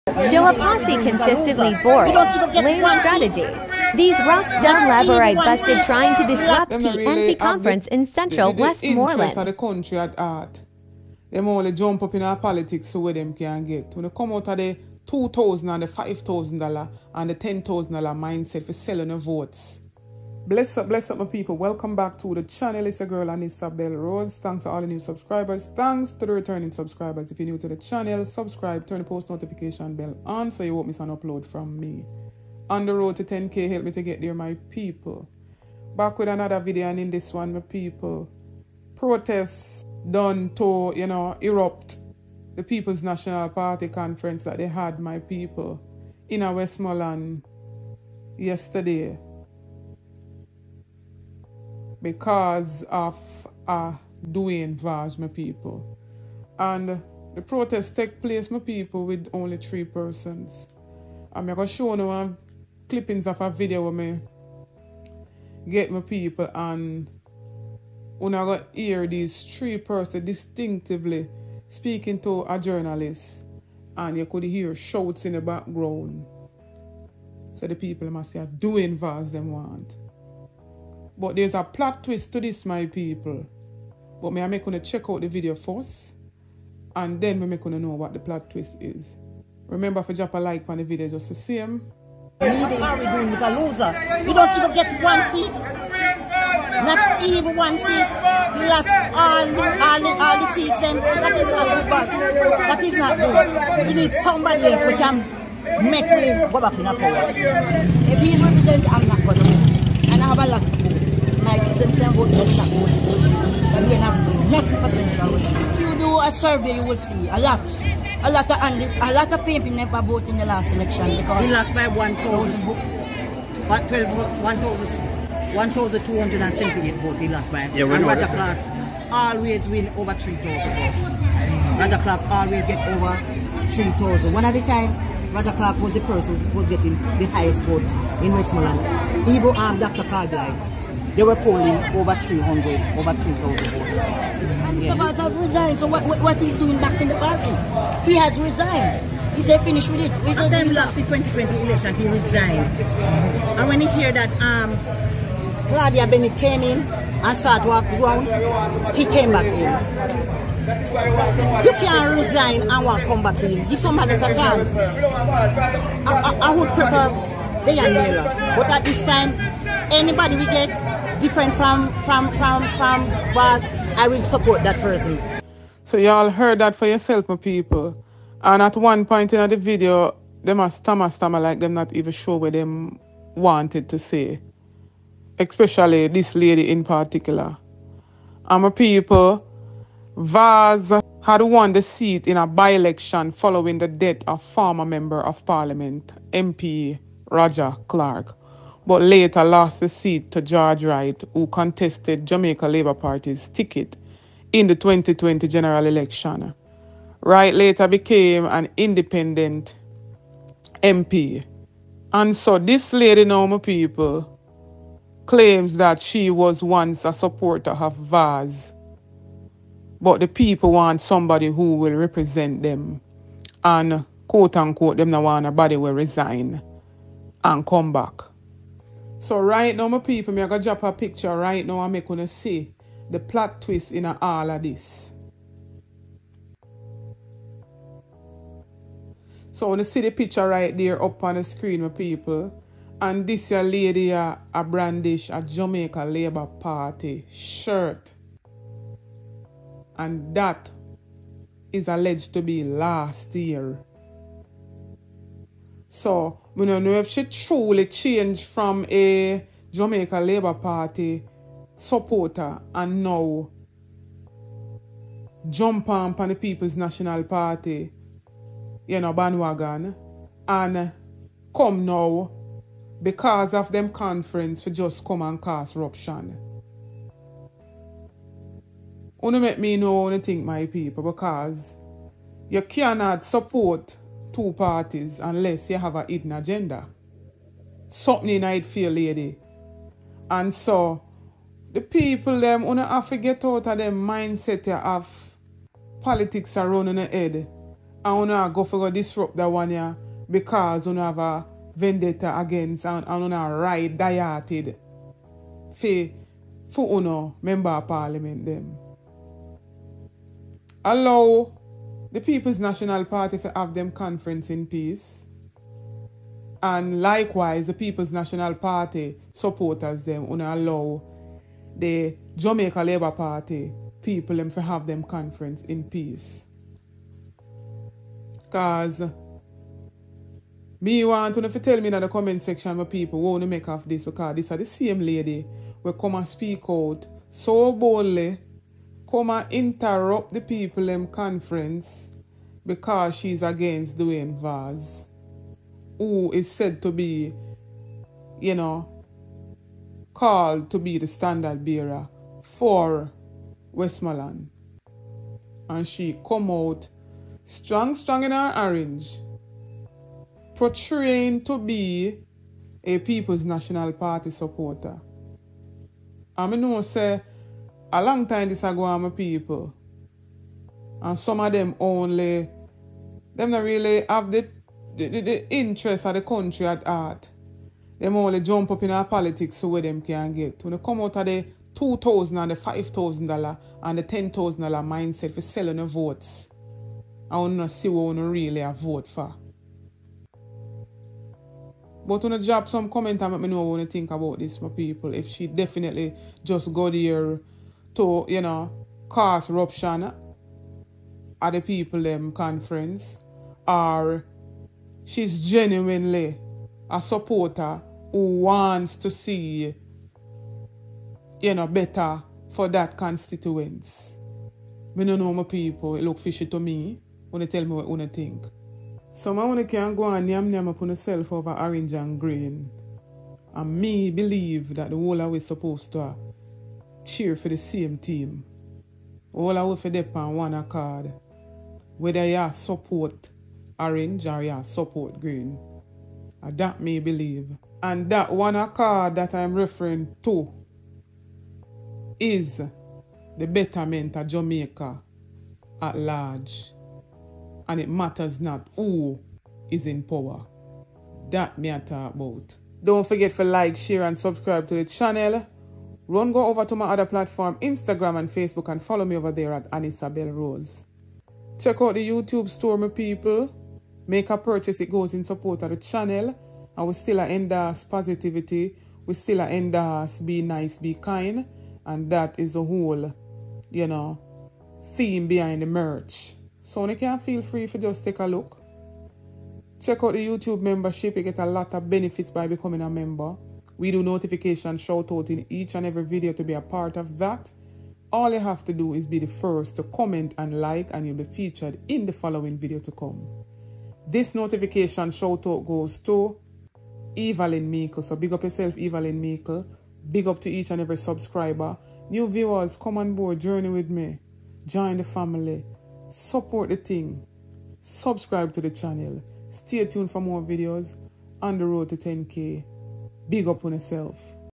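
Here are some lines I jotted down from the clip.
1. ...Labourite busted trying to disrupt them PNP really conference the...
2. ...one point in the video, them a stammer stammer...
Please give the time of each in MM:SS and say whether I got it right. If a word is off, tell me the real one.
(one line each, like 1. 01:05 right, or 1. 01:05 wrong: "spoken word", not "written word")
1. 00:04 right
2. 02:58 right.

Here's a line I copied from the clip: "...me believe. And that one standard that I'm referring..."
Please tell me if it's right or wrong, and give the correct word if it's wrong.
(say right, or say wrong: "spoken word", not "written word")
wrong: "accord", not "standard".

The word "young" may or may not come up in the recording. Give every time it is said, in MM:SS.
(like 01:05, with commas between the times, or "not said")
02:47.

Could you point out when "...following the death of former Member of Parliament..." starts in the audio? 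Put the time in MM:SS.
03:13.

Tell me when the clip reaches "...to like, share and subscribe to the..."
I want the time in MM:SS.
07:33.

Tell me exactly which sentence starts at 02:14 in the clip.
One at a time, Roger Clarke was the person who was getting the highest vote in Westmoreland.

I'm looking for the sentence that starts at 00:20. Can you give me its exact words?
Bless up, bless up, my people.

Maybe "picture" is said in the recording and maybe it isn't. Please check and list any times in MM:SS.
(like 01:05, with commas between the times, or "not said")
03:50, 04:00.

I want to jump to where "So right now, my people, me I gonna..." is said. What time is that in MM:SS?
03:49.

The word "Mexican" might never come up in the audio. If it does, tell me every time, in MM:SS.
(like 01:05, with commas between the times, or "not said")
not said.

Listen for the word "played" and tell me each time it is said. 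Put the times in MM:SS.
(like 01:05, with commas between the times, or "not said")
not said.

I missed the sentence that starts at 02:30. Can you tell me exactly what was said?
We After he lost the 2020 election, he resigned.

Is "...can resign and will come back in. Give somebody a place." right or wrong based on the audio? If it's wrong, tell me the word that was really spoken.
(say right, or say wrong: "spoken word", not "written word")
wrong: "chance", not "place".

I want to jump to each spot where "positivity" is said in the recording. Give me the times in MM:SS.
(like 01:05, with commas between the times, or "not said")
07:47.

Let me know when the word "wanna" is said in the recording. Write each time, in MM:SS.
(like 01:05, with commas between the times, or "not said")
06:27, 06:59.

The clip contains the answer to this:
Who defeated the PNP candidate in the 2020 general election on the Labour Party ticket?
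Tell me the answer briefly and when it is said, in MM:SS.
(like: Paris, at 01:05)
George Wright, at 03:20.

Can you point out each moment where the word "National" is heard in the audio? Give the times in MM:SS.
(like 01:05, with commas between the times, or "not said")
00:43, 04:26, 05:12, 05:18, 06:03.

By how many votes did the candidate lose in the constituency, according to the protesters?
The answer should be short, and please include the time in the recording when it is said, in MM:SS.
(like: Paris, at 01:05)
1,278, at 02:05.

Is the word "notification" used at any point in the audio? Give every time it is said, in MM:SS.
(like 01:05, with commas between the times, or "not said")
00:29, 08:04, 08:14.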